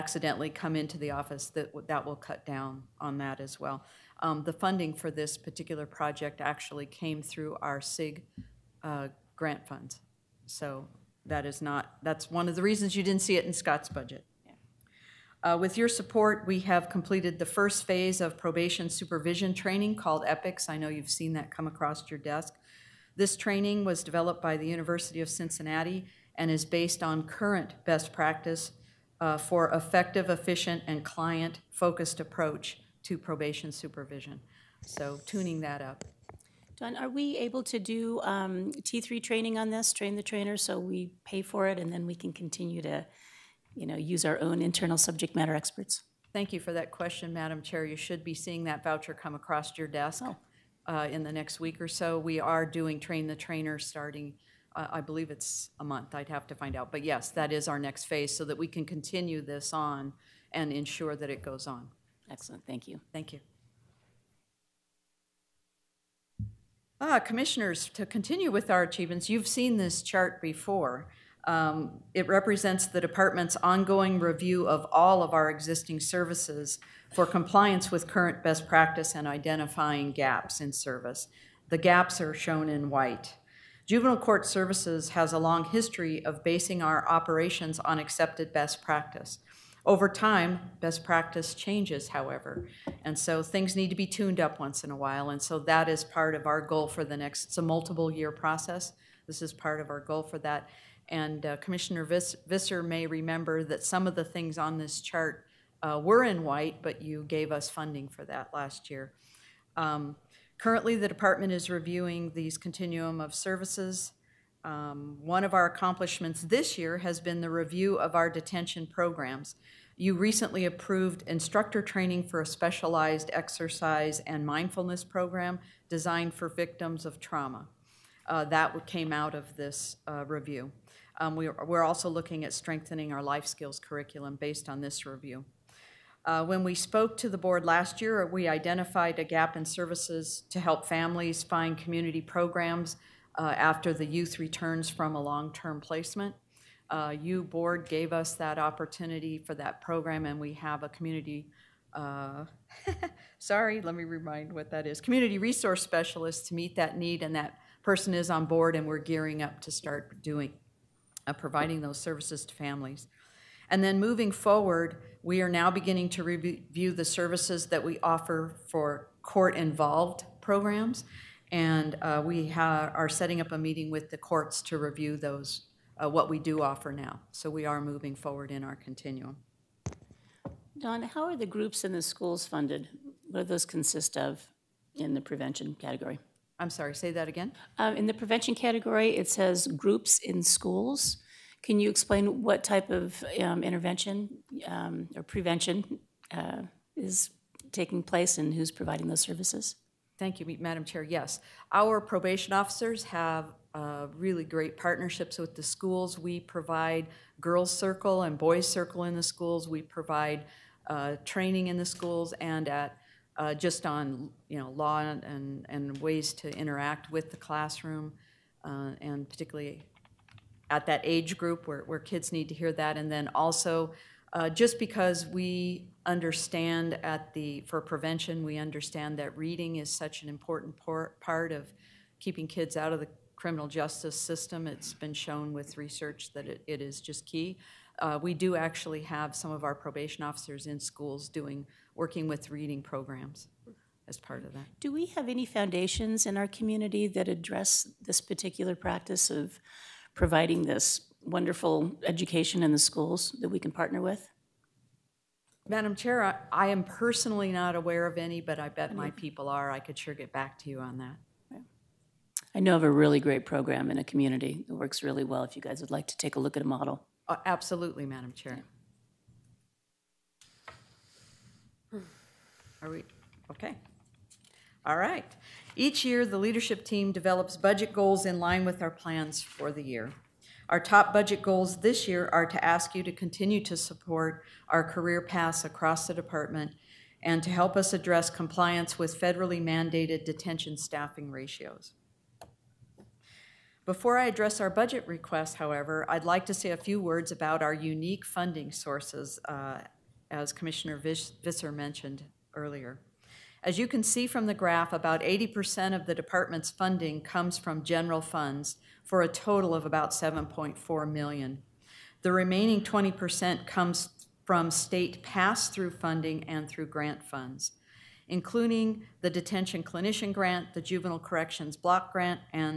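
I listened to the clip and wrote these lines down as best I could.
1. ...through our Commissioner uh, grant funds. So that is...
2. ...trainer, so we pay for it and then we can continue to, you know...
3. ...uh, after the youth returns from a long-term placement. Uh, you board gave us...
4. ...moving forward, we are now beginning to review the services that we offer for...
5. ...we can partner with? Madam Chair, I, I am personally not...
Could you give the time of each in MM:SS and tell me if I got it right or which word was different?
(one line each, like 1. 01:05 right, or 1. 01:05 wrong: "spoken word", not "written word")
1. 00:07 wrong: "SIG", not "Commissioner"
2. 00:40 right
3. 02:23 right
4. 02:43 right
5. 04:13 right.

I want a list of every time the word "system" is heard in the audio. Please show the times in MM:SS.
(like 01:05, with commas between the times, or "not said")
03:54.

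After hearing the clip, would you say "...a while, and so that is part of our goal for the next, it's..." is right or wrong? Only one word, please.
right.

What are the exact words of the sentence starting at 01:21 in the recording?
The gaps are shown in white.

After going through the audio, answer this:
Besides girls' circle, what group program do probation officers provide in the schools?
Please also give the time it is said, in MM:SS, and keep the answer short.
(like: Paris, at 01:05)
boys' circle, at 03:28.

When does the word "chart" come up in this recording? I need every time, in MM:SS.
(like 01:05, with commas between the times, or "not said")
01:10, 01:45.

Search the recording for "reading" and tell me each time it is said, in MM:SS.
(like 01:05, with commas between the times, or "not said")
03:49, 04:02.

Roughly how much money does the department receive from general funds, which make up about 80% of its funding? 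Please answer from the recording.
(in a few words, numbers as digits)
7.4 million.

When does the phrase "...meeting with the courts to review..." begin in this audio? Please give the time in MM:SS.
02:53.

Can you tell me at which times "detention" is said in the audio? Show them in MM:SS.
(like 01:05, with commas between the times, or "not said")
01:58, 04:50, 05:19.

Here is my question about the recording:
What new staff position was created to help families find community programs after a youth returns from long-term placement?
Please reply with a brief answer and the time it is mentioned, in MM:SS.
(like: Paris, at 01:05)
Community resource specialist, at 02:35.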